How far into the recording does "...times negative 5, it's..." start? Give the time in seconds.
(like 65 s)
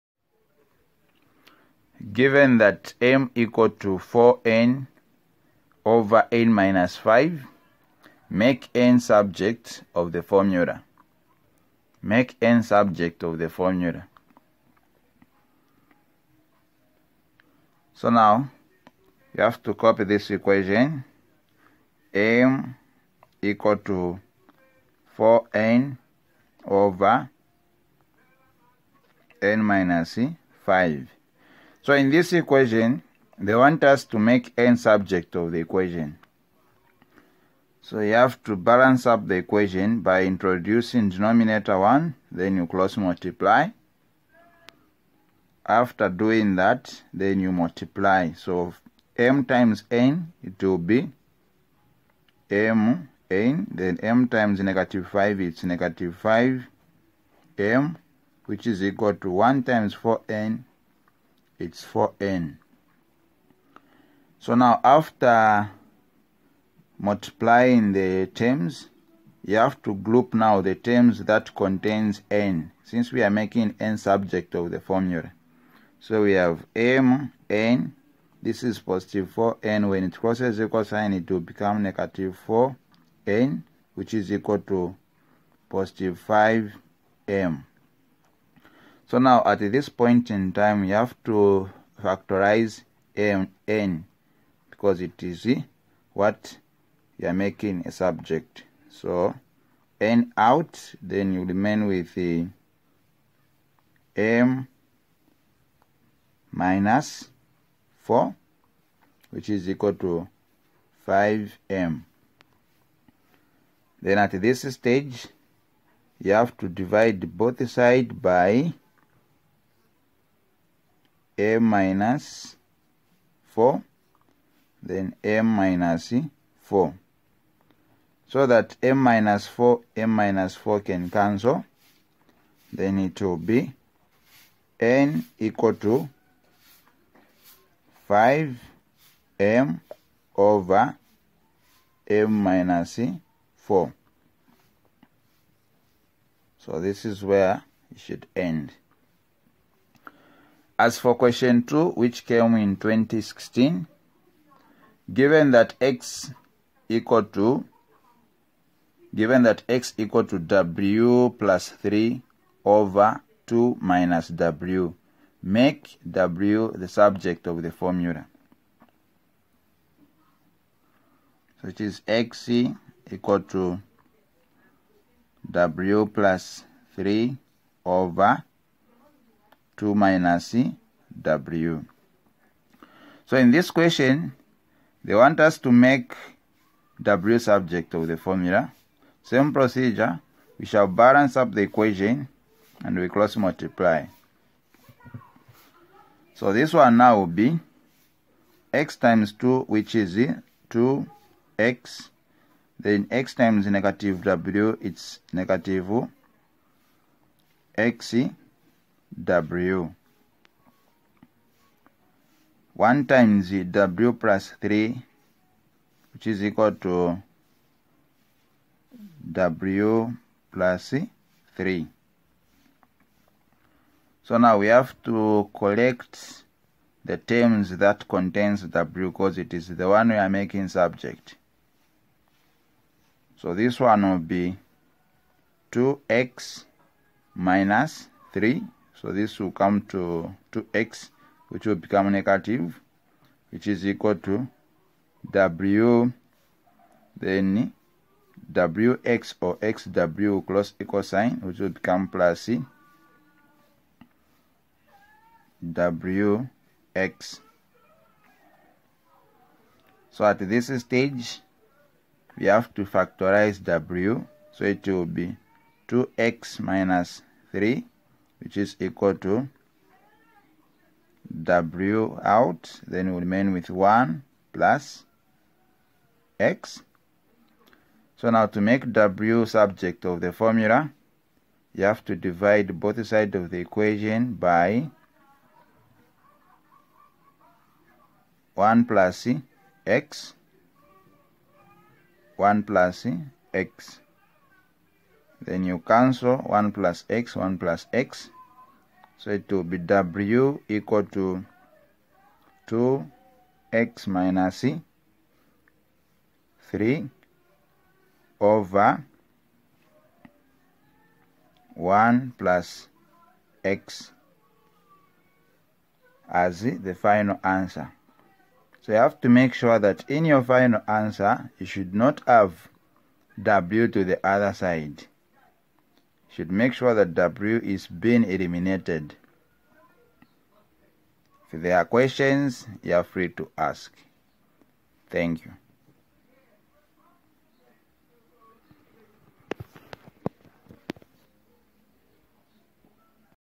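54 s.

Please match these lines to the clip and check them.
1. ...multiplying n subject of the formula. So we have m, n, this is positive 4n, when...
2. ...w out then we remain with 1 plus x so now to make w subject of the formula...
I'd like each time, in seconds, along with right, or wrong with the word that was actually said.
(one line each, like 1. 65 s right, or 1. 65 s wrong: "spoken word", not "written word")
1. 73 s wrong: "making", not "multiplying"
2. 271 s right.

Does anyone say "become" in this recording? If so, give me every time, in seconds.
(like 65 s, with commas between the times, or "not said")
81 s, 241 s, 251 s.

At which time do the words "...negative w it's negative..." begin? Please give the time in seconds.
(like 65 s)
203 s.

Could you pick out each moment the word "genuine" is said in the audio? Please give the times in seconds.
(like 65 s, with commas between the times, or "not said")
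not said.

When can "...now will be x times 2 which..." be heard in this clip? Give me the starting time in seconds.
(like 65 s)
196 s.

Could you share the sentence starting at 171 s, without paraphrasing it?
So it is x equal to w plus 3 over 2 minus w.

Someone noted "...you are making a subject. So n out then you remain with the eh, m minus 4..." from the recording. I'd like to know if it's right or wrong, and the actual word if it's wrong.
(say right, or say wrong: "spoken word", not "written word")
right.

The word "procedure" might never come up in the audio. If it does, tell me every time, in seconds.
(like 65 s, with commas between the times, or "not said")
189 s.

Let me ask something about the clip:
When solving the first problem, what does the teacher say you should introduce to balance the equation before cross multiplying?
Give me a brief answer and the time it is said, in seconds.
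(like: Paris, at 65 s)
denominator 1, at 41 s.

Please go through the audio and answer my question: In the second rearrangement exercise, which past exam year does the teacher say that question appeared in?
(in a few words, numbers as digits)
2016.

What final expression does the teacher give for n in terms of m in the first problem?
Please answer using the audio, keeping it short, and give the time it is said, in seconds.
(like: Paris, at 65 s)
5m over m minus 4, at 138 s.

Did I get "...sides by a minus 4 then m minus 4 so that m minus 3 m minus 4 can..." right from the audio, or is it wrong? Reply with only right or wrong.
wrong.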